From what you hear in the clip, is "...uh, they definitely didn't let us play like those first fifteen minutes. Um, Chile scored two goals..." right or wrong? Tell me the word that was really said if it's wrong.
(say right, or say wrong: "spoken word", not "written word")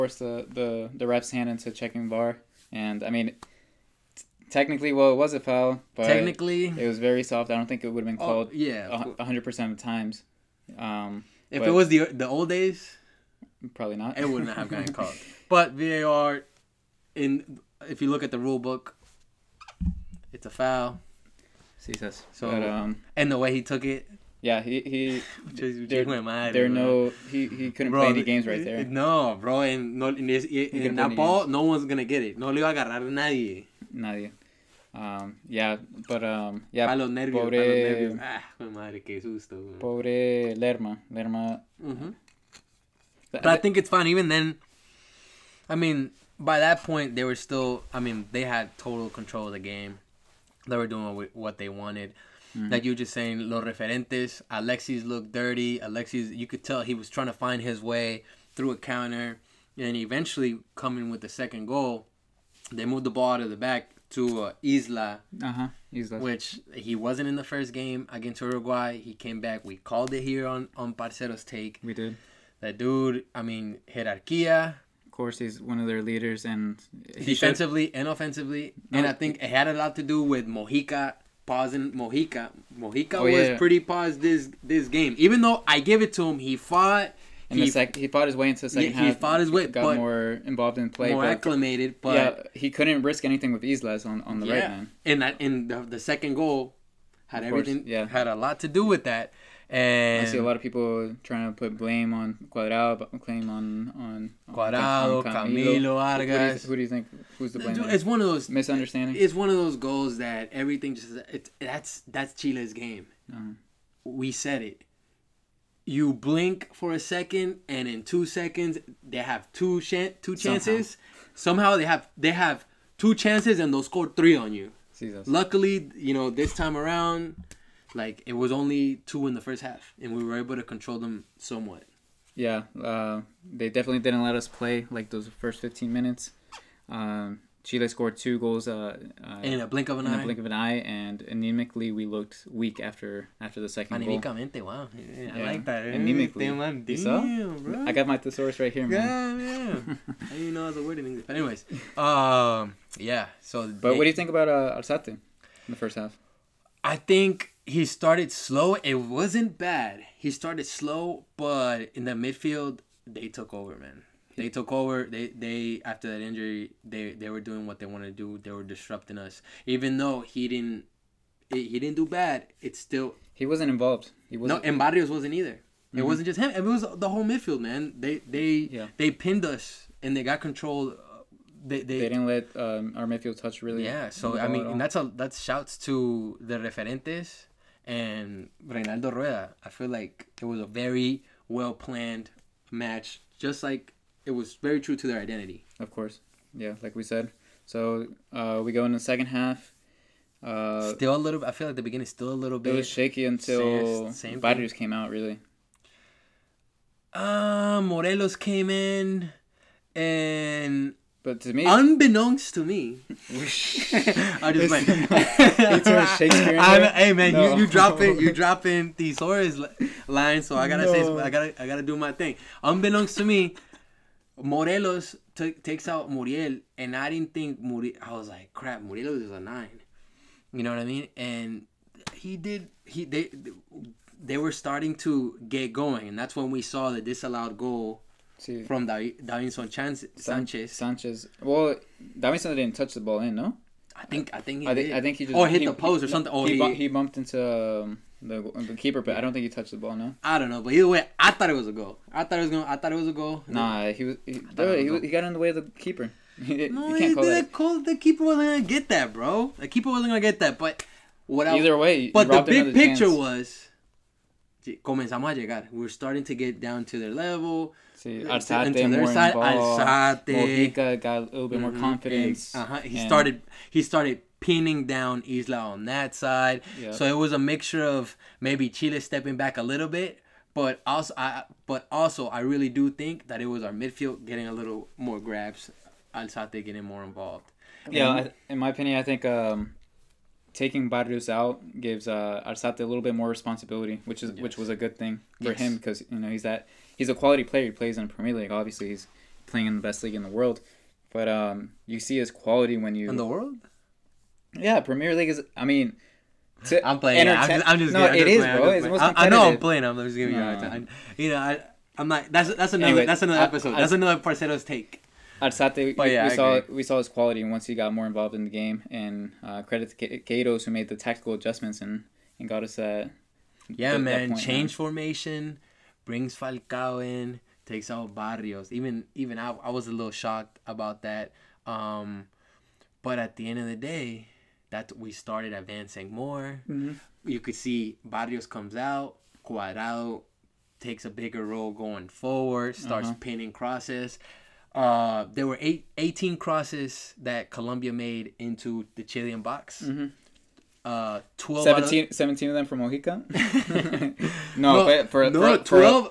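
right.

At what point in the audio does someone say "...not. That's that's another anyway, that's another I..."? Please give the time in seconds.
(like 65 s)
312 s.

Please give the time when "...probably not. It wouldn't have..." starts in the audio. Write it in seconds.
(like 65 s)
13 s.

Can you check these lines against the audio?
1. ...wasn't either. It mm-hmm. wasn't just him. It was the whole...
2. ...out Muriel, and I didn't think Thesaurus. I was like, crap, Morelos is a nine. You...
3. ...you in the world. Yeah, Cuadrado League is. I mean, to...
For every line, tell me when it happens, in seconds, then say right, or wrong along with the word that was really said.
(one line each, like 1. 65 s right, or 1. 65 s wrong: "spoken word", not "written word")
1. 175 s right
2. 225 s wrong: "Muriel", not "Thesaurus"
3. 302 s wrong: "Premier", not "Cuadrado".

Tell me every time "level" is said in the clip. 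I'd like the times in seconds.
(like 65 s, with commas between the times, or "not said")
267 s.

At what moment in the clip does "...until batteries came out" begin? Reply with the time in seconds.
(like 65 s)
203 s.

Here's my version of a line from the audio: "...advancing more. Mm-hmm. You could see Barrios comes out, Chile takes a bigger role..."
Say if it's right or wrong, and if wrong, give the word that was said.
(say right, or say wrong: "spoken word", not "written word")
wrong: "Cuadrado", not "Chile".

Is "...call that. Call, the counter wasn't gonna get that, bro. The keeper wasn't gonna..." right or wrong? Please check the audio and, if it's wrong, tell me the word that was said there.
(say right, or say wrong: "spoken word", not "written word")
wrong: "keeper", not "counter".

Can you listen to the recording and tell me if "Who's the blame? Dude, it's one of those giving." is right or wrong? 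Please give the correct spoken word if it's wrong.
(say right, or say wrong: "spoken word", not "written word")
wrong: "misunderstanding", not "giving".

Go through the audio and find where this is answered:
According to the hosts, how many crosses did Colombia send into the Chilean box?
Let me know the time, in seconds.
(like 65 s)
345 s.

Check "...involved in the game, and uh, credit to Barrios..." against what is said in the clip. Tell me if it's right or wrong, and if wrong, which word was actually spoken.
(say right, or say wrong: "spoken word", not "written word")
wrong: "Gatos", not "Barrios".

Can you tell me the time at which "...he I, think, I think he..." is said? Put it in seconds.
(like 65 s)
244 s.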